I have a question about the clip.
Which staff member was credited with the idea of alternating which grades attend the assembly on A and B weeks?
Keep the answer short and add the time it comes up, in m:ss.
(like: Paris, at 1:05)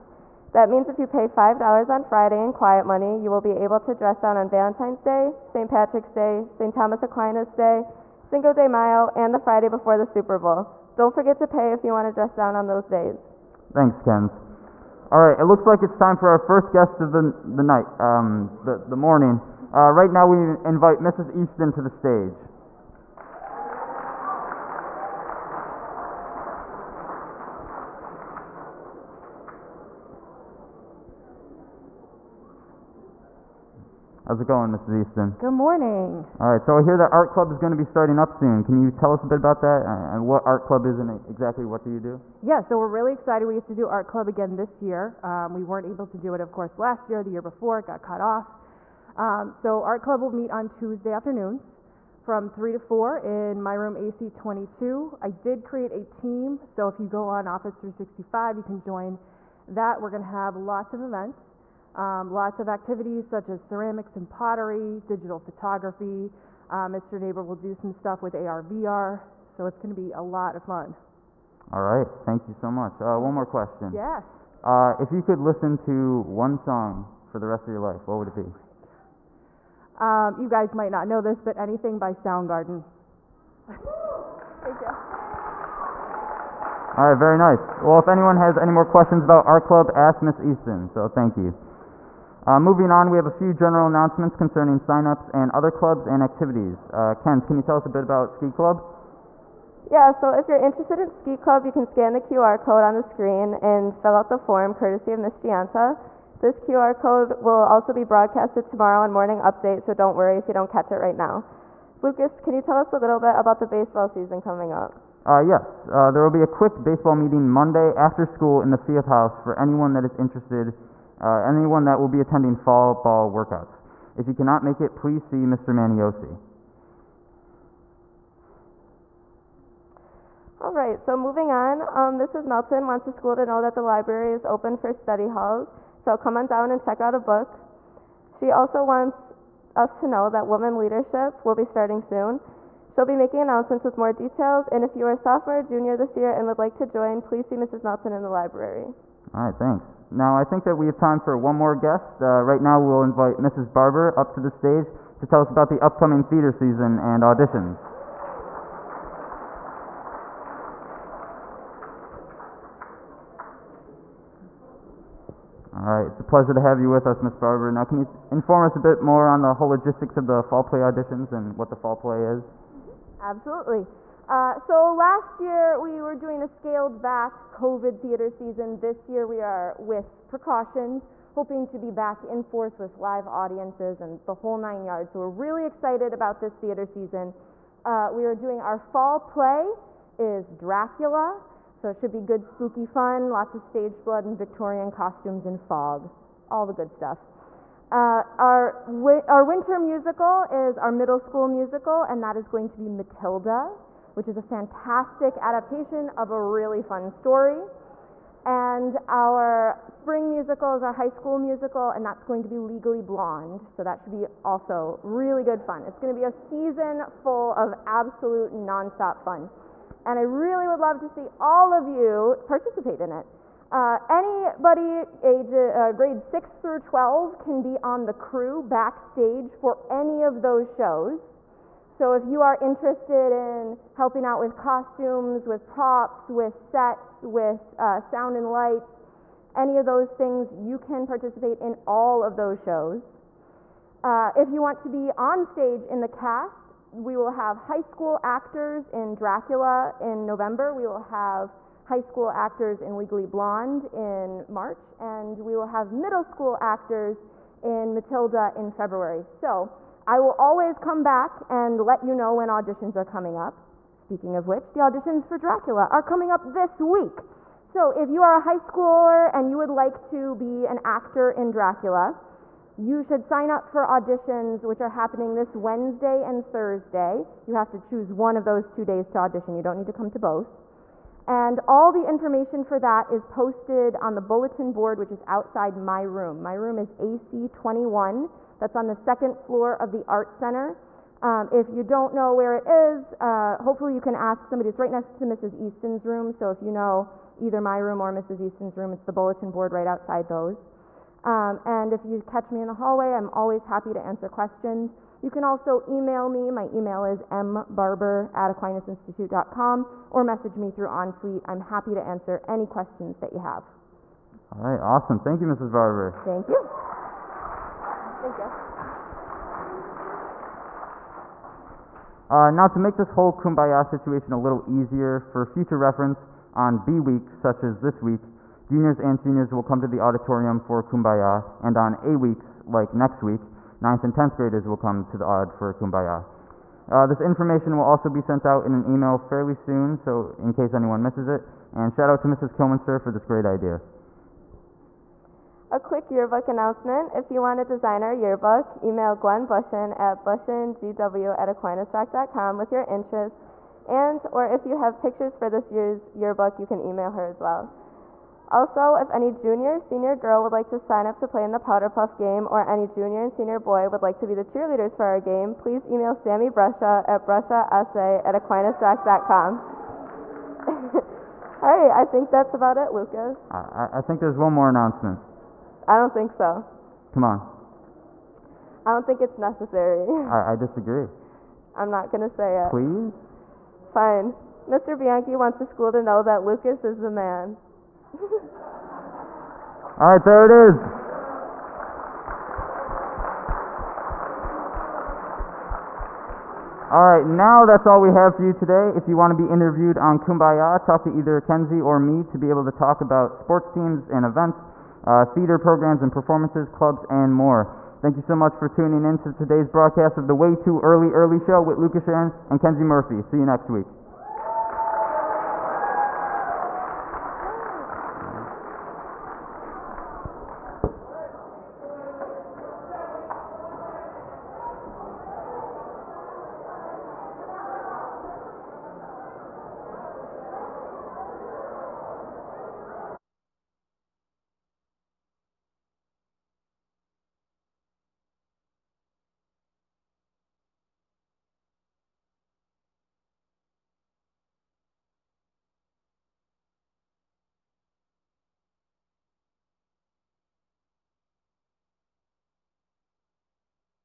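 Mrs. Kilminster, at 5:42.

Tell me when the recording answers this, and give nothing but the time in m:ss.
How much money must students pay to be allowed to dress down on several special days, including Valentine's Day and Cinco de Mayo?
0:01.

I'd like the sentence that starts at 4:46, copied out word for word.
My room is AC21, that's on the second floor of the Art Center.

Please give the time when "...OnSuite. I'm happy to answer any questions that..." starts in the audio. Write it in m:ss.
5:10.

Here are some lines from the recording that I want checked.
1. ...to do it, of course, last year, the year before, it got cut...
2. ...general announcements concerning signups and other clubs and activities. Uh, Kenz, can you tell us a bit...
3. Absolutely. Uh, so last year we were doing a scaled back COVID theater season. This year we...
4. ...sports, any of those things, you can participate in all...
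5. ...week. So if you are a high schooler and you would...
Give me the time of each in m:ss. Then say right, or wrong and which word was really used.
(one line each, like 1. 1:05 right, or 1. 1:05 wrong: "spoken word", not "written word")
1. 0:46 right
2. 1:33 right
3. 2:53 right
4. 3:58 wrong: "lights", not "sports"
5. 4:26 right.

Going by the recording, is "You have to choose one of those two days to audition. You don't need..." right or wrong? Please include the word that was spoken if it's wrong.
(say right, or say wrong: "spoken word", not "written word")
right.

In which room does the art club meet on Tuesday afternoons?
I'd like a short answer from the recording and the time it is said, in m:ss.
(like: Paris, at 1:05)
AC 22, at 0:53.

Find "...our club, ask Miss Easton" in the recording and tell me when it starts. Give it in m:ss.
1:29.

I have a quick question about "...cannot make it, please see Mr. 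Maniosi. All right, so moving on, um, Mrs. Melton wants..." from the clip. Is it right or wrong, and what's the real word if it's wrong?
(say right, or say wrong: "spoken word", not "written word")
right.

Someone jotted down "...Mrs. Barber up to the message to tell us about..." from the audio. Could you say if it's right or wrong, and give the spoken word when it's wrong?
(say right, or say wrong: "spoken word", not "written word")
wrong: "stage", not "message".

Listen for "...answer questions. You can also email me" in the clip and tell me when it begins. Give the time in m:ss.
5:04.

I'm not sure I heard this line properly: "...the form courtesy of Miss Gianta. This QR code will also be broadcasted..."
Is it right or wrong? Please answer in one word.
right.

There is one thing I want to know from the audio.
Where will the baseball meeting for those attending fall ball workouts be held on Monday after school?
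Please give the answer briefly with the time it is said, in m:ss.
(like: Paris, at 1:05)
Field House, at 1:58.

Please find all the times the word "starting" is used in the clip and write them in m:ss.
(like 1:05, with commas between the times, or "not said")
0:37, 2:21.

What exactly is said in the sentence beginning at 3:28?
And our spring musical is our high school musical, and that's going to be Legally Blonde.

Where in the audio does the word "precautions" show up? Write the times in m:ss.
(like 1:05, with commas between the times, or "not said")
3:00.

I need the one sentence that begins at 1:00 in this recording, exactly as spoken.
We're going to have lots of events.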